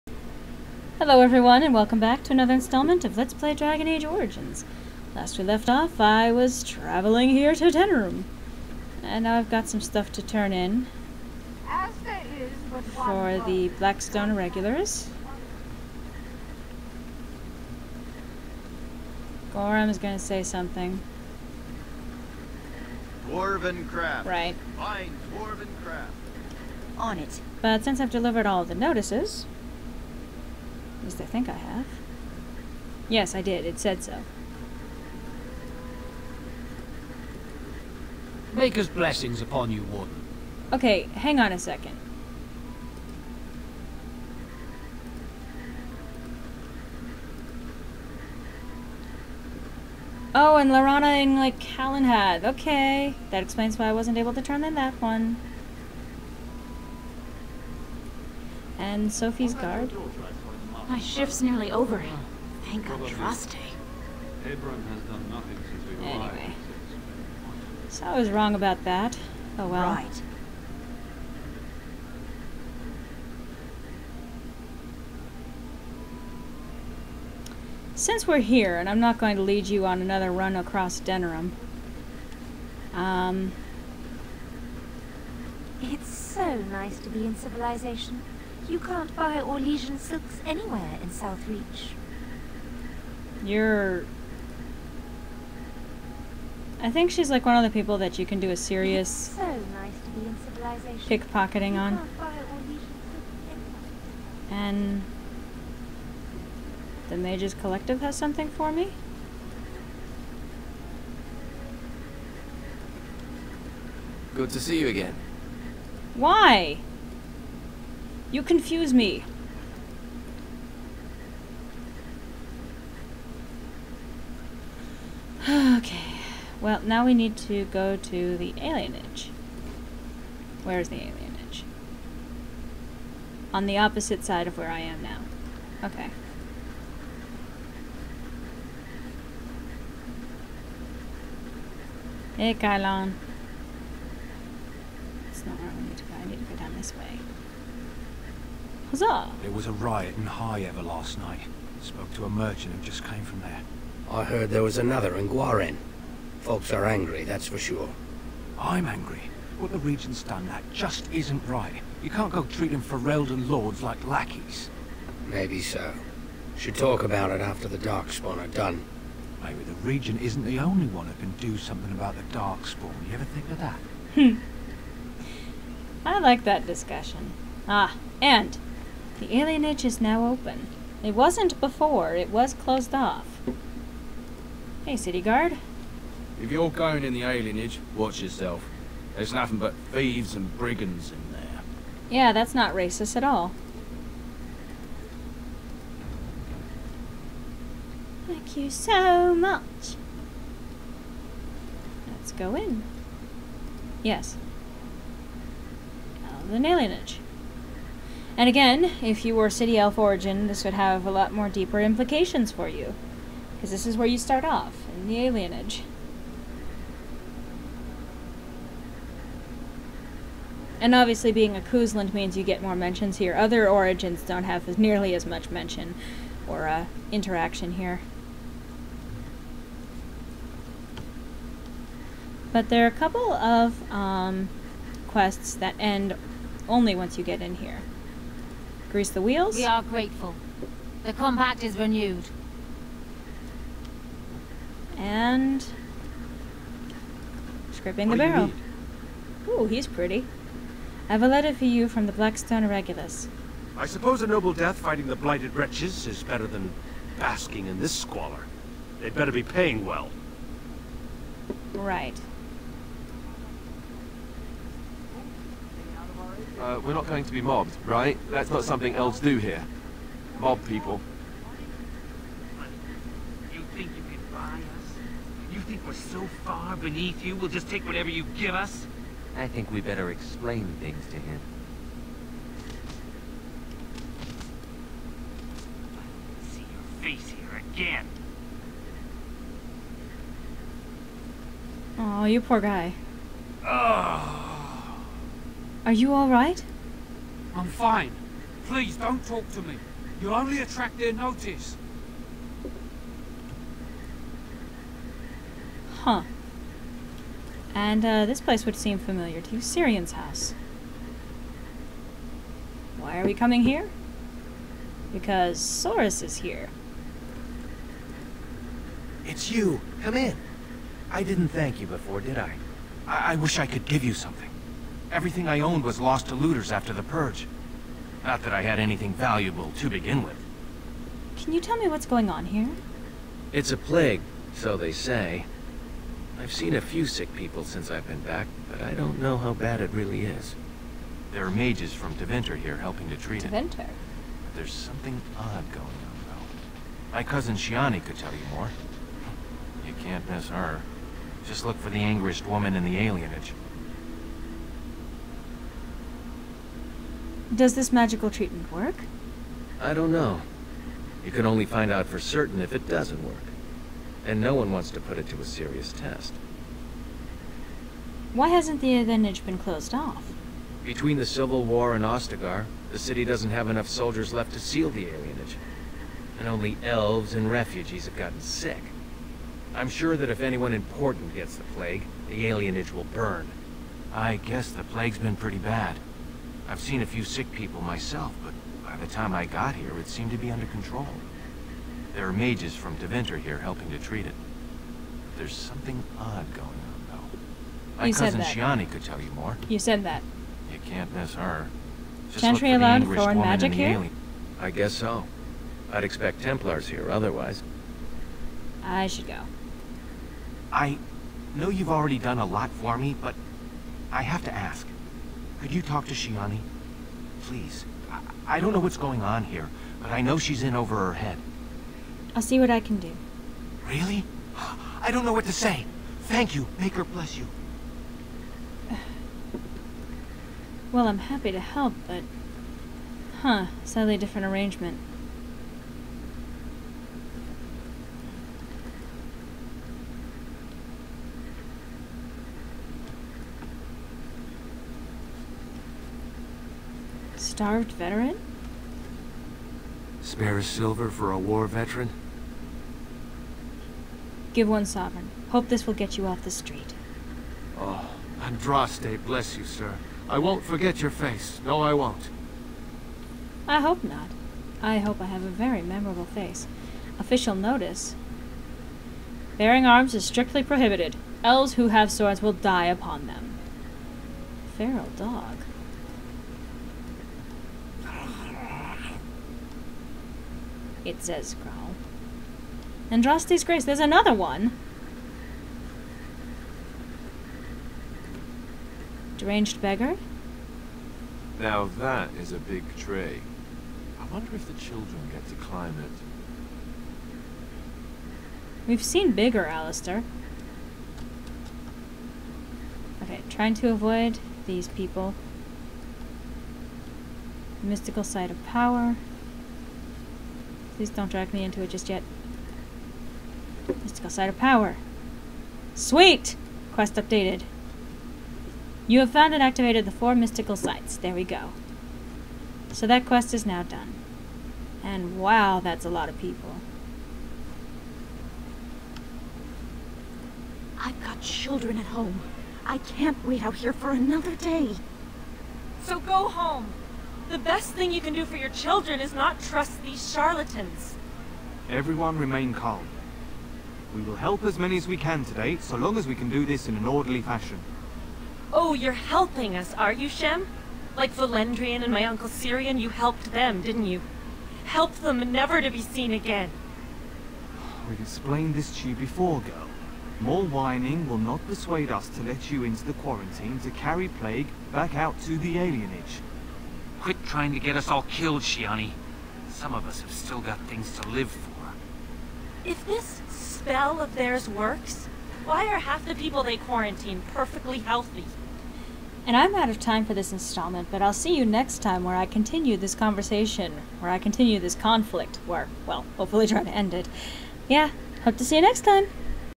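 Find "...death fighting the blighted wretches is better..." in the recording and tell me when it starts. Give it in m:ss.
4:14.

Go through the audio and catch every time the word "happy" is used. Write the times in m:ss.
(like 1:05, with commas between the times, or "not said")
7:11.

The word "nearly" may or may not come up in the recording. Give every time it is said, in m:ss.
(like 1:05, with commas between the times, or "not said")
1:01, 3:44.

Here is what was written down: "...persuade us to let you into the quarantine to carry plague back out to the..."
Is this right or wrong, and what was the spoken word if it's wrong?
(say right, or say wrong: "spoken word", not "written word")
right.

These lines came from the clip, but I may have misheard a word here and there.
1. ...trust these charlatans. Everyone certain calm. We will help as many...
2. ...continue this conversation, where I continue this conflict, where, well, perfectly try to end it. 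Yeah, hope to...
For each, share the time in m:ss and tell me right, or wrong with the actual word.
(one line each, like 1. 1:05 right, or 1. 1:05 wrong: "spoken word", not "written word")
1. 8:59 wrong: "remain", not "certain"
2. 9:42 wrong: "hopefully", not "perfectly".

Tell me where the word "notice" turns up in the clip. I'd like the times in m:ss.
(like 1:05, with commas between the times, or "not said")
0:28, 5:01, 7:47.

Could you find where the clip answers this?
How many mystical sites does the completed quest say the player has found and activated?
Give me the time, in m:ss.
8:40.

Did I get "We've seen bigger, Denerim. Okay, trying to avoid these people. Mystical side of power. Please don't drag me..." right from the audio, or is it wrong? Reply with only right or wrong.
wrong.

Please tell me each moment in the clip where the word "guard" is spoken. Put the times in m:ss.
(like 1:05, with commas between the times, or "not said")
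0:59, 3:05.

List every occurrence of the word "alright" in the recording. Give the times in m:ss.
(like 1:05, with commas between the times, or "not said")
4:56.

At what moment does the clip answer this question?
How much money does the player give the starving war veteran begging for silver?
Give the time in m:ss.
7:34.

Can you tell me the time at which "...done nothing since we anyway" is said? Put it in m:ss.
1:05.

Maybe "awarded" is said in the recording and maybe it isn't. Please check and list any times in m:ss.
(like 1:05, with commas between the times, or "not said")
not said.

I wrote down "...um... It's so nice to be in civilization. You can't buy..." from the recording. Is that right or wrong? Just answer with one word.
right.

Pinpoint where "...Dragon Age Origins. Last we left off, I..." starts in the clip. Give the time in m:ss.
0:03.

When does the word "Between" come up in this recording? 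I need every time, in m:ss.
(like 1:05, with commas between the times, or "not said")
6:10.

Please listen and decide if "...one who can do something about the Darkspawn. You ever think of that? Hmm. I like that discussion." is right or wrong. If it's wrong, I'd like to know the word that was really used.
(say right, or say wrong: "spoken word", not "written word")
right.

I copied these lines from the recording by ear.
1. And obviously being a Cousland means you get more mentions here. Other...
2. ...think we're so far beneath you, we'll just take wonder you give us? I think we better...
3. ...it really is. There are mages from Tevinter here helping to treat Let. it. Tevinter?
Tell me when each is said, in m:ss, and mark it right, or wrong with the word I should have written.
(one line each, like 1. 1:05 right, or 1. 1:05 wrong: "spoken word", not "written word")
1. 3:40 right
2. 4:35 wrong: "whatever", not "wonder"
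3. 5:39 wrong: "Tevinter", not "Let".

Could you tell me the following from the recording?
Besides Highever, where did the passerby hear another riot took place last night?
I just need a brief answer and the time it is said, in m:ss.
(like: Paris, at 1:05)
Gwaren, at 2:35.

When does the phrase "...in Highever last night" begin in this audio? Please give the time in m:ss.
2:30.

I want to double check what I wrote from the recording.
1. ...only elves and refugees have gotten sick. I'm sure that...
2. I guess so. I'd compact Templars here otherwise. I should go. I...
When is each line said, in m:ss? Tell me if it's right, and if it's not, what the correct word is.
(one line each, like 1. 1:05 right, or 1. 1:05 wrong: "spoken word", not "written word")
1. 6:16 right
2. 6:44 wrong: "expect", not "compact".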